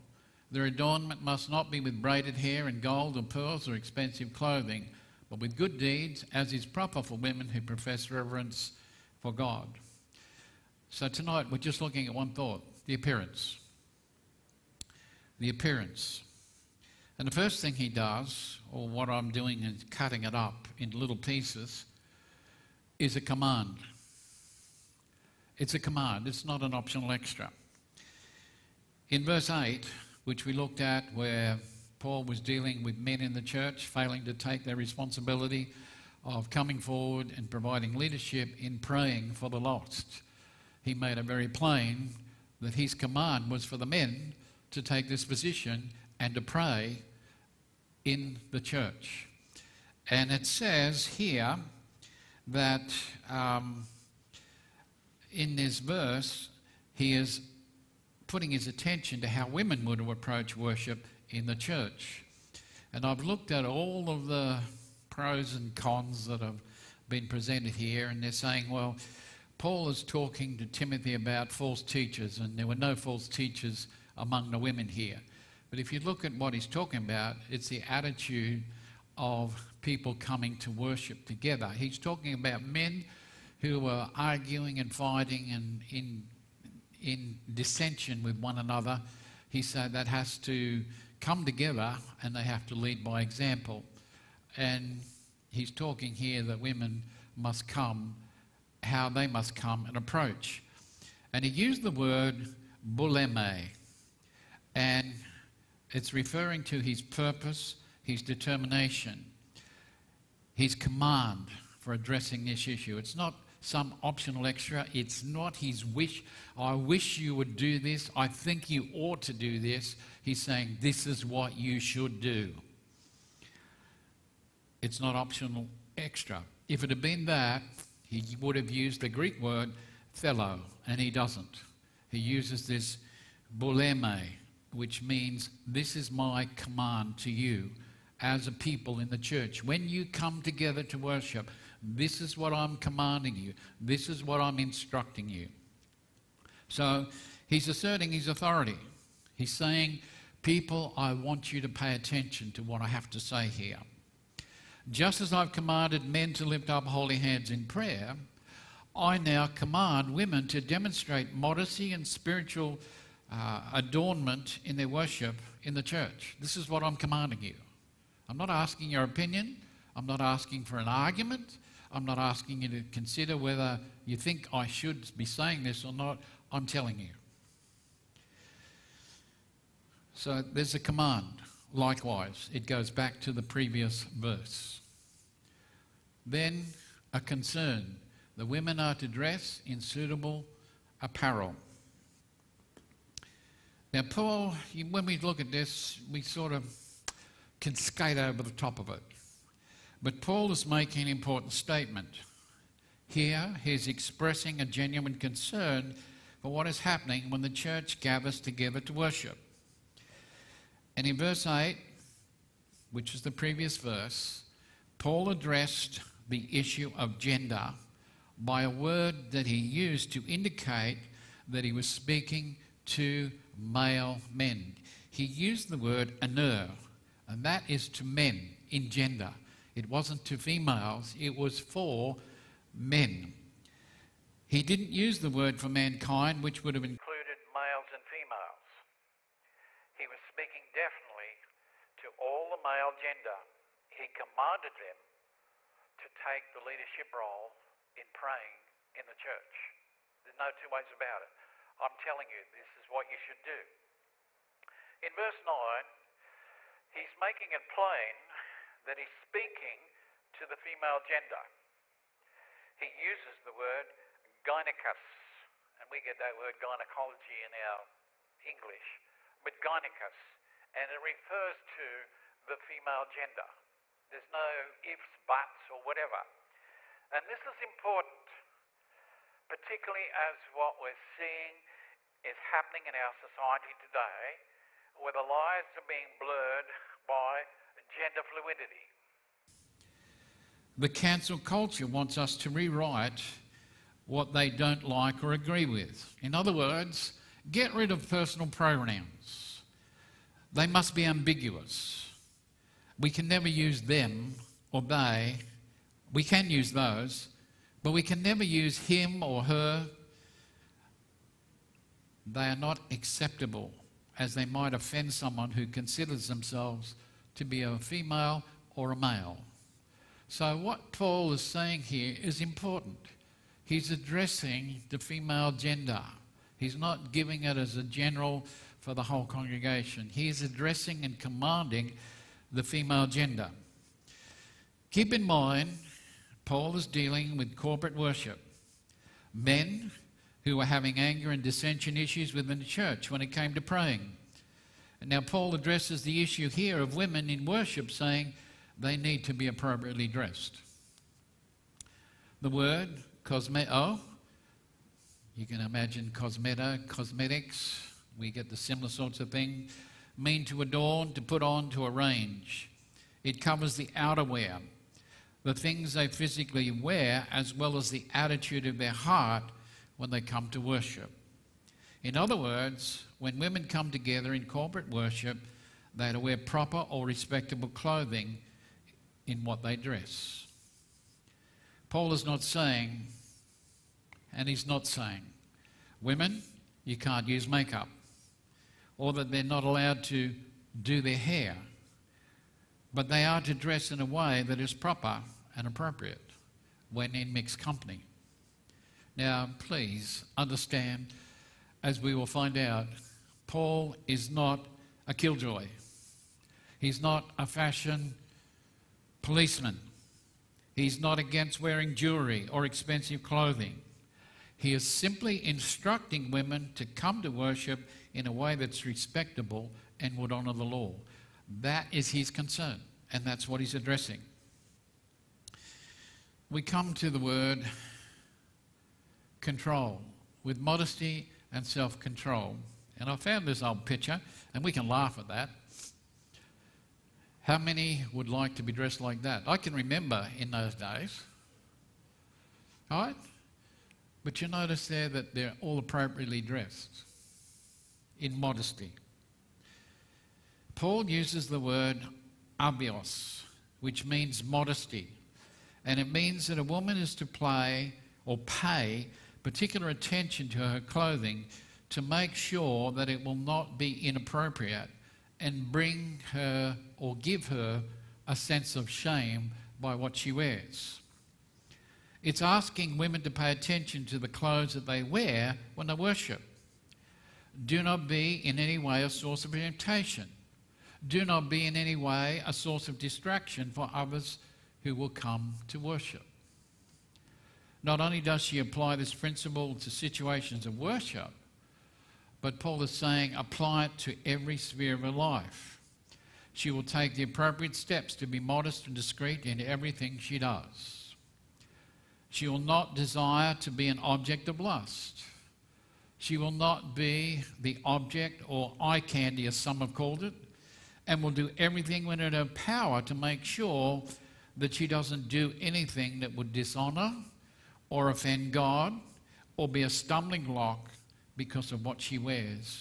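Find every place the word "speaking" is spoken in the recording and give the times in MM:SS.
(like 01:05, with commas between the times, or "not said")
03:41, 04:00, 04:19.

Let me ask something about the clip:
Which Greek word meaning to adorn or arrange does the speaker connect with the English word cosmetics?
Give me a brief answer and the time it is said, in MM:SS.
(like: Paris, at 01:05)
cosmeto, at 05:53.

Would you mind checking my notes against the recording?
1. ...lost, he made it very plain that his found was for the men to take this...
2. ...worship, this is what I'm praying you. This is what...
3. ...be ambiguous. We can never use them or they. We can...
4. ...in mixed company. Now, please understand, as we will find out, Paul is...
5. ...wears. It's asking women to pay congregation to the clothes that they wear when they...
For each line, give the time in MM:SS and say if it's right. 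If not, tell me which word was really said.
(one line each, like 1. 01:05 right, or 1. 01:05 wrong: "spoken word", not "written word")
1. 00:39 wrong: "command", not "found"
2. 02:20 wrong: "commanding", not "praying"
3. 05:00 right
4. 06:37 right
5. 07:50 wrong: "attention", not "congregation".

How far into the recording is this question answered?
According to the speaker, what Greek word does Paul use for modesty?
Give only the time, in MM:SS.
07:32.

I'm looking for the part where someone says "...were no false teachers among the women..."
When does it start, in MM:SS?
01:12.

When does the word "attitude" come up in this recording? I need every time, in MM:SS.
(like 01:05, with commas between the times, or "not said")
01:17, 06:08.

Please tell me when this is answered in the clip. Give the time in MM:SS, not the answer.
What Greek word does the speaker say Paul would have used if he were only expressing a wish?
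02:10.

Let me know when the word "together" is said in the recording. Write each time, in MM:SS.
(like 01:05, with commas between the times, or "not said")
01:21, 01:31, 02:20, 03:28, 06:13.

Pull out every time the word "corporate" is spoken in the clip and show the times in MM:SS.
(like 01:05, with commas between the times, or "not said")
05:37, 06:14.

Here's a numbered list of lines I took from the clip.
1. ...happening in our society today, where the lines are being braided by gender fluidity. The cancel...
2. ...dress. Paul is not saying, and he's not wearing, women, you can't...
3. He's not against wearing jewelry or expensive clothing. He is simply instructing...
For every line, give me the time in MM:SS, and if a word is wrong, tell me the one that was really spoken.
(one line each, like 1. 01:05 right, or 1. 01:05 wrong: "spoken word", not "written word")
1. 04:42 wrong: "blurred", not "braided"
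2. 06:19 wrong: "saying", not "wearing"
3. 06:50 right.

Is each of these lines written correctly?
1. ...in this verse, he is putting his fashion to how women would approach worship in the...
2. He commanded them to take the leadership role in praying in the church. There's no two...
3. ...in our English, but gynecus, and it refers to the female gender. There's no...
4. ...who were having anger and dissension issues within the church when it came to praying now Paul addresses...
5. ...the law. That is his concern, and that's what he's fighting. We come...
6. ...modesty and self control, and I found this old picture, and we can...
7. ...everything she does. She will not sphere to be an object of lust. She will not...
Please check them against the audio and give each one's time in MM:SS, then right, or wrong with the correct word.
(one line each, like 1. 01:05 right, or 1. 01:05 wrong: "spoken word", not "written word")
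1. 00:55 wrong: "attention", not "fashion"
2. 04:03 right
3. 04:27 right
4. 05:40 right
5. 07:00 wrong: "addressing", not "fighting"
6. 07:10 right
7. 08:19 wrong: "desire", not "sphere".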